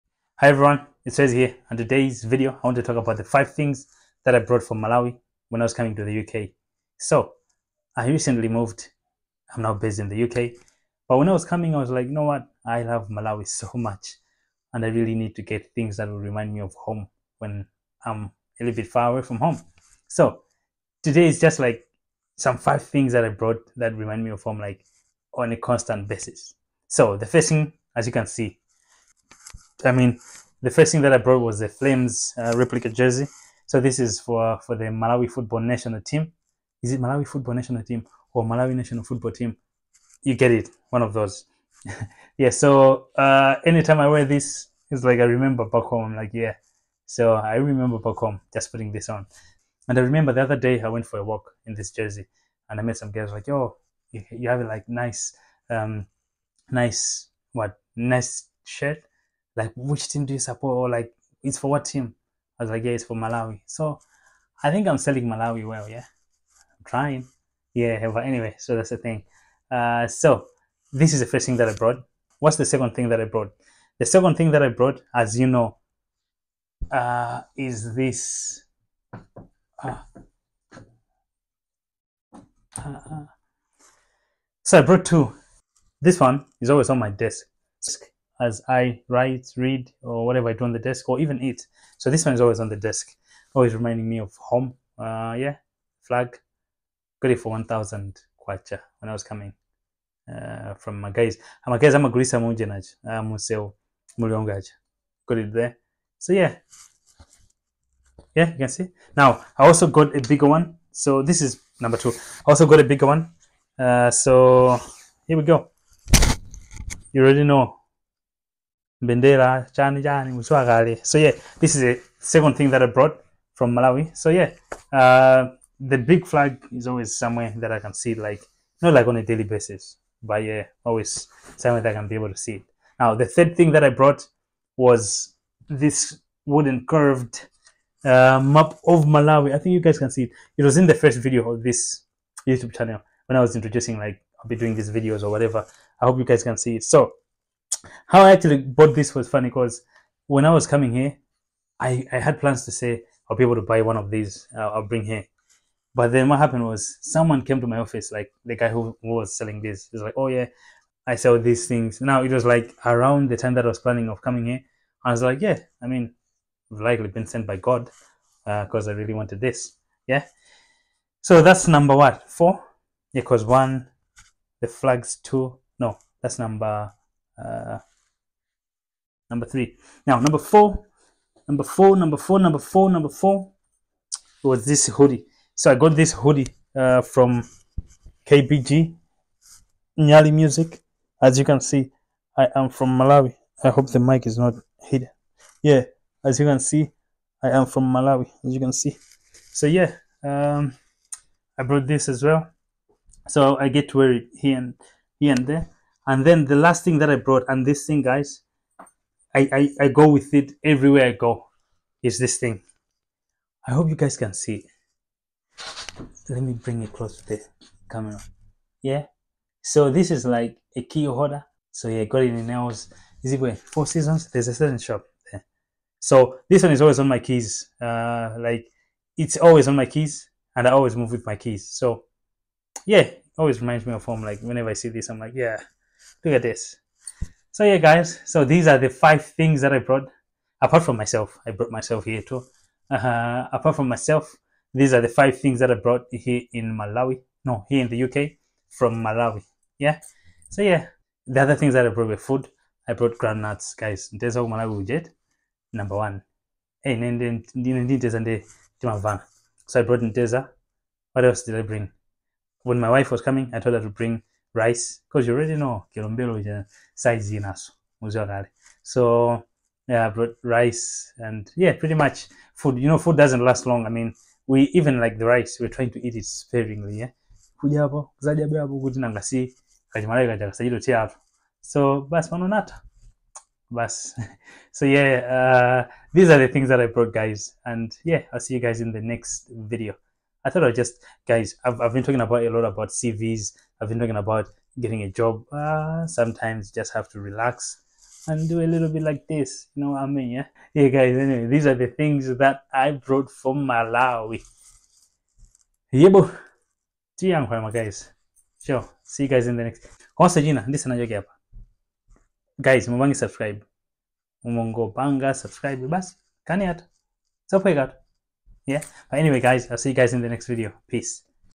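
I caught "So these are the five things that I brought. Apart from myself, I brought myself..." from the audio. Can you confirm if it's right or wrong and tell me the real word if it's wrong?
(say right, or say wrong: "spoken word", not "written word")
right.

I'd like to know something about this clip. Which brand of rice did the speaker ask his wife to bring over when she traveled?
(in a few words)
Kilombero.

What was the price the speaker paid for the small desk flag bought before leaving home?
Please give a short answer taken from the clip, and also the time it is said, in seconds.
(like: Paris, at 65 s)
1,000 kwacha, at 97 s.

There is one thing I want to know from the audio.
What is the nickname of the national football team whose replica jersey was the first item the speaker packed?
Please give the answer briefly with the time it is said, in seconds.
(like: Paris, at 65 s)
Flames, at 31 s.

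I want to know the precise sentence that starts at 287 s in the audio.
And yeah, I'll see you guys in the next video.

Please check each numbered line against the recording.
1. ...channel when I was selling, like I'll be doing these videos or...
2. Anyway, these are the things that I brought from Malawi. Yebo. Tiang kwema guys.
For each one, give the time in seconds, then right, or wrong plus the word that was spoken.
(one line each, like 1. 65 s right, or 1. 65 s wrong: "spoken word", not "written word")
1. 142 s wrong: "introducing", not "selling"
2. 301 s right.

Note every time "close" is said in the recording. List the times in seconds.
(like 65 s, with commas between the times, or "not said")
216 s.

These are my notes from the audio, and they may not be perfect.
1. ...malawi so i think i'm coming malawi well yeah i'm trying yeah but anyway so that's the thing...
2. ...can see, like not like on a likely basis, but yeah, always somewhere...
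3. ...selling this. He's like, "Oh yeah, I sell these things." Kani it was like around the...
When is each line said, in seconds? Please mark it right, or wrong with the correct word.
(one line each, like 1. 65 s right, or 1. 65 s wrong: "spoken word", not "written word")
1. 63 s wrong: "selling", not "coming"
2. 127 s wrong: "daily", not "likely"
3. 159 s wrong: "Now", not "Kani".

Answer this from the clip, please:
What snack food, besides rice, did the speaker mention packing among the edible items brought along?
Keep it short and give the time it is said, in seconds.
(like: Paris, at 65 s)
Groundnuts, at 253 s.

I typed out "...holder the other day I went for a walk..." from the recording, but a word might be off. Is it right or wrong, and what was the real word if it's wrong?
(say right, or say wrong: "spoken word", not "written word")
wrong: "remember", not "holder".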